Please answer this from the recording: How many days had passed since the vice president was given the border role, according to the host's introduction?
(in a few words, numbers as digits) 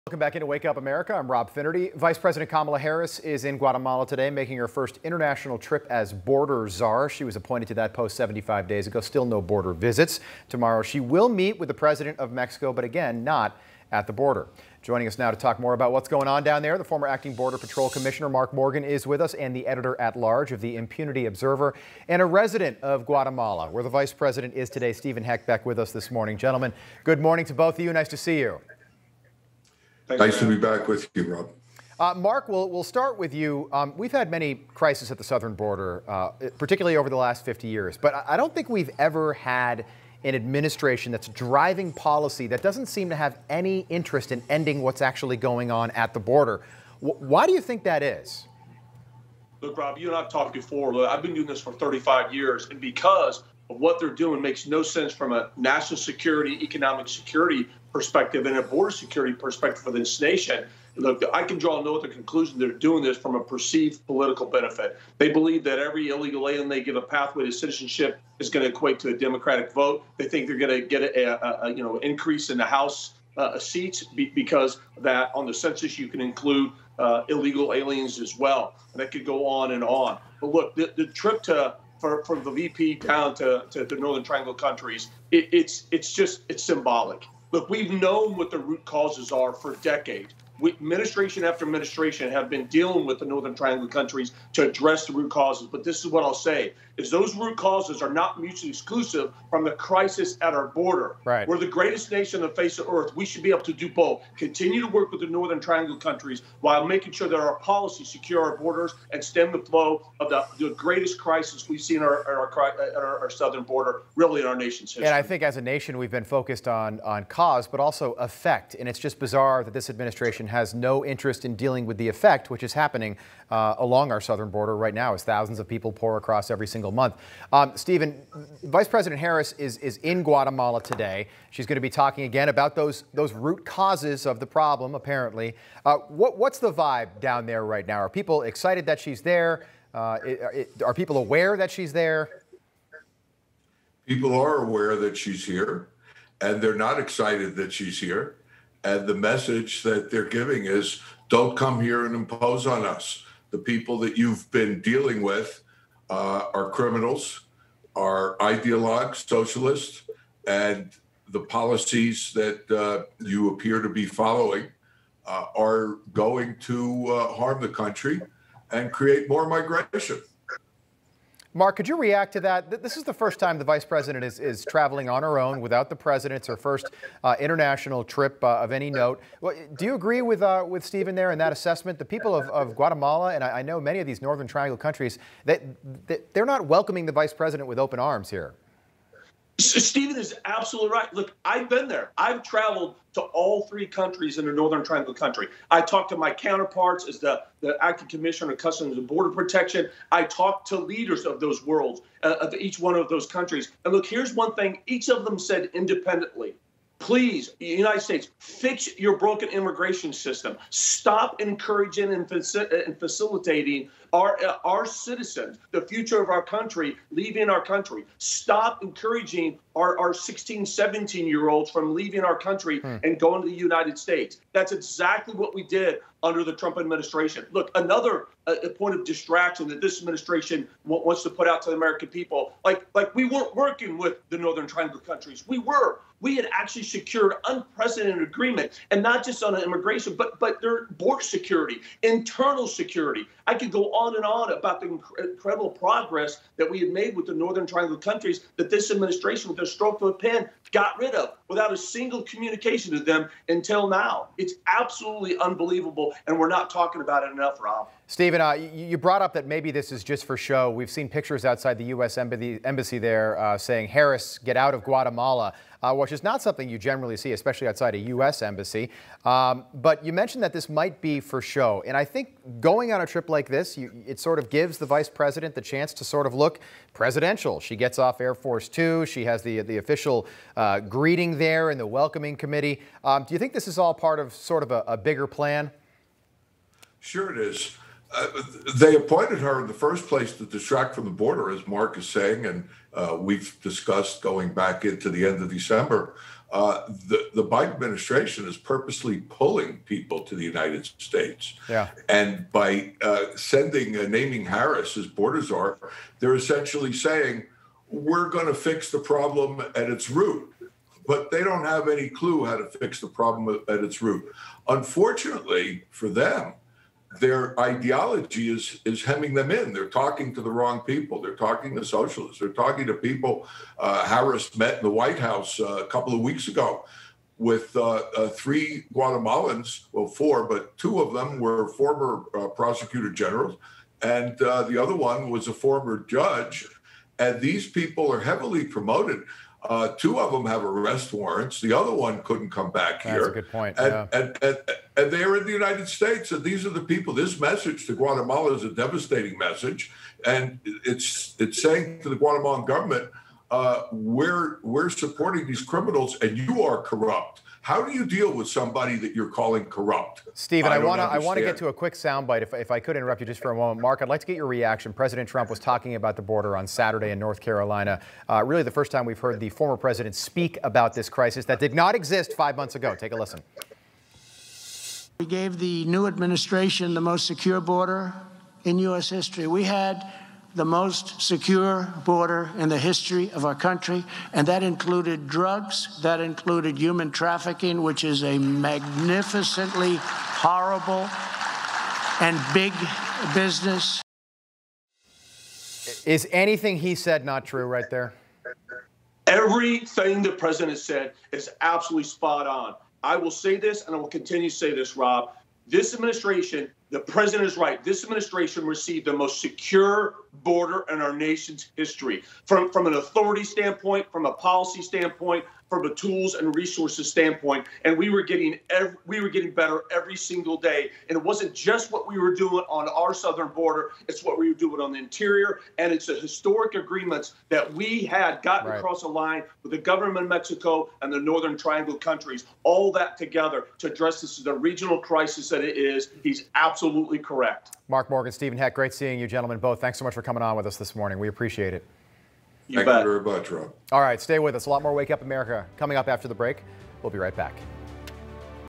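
75.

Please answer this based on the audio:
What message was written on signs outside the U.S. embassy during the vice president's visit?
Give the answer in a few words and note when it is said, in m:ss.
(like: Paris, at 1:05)
Harris, get out of Guatemala, at 4:23.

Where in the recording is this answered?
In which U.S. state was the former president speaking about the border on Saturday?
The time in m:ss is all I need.
6:07.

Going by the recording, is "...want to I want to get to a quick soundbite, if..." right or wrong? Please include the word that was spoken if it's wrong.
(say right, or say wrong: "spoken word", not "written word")
right.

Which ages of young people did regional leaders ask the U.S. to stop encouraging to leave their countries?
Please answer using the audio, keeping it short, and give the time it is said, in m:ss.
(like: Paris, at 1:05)
16, 17, at 3:40.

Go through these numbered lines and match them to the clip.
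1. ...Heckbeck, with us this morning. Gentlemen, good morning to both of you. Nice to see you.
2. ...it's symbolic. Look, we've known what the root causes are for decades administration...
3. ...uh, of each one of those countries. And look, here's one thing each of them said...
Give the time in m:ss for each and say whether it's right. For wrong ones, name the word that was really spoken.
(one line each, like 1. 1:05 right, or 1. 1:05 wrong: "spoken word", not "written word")
1. 0:25 right
2. 1:26 right
3. 3:22 right.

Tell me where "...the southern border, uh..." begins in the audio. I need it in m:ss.
0:35.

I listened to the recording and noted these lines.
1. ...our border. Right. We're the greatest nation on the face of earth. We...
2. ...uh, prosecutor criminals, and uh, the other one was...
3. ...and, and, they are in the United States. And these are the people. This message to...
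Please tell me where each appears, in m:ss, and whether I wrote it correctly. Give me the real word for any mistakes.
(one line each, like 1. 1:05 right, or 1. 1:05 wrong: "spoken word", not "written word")
1. 1:40 right
2. 5:32 wrong: "generals", not "criminals"
3. 5:44 right.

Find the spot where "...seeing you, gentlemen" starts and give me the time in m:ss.
7:18.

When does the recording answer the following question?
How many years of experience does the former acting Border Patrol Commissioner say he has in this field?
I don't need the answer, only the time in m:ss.
0:51.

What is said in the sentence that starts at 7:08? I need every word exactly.
across the line with the government of Mexico and the Northern Triangle countries.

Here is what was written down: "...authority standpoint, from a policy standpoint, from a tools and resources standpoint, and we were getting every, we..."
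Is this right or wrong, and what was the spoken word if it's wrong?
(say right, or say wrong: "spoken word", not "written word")
right.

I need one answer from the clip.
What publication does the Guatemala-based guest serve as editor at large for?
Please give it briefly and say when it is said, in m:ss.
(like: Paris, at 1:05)
Impunity Observer, at 0:20.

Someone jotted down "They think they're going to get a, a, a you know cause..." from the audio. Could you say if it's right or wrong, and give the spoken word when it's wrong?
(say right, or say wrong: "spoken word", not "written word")
wrong: "increase", not "cause".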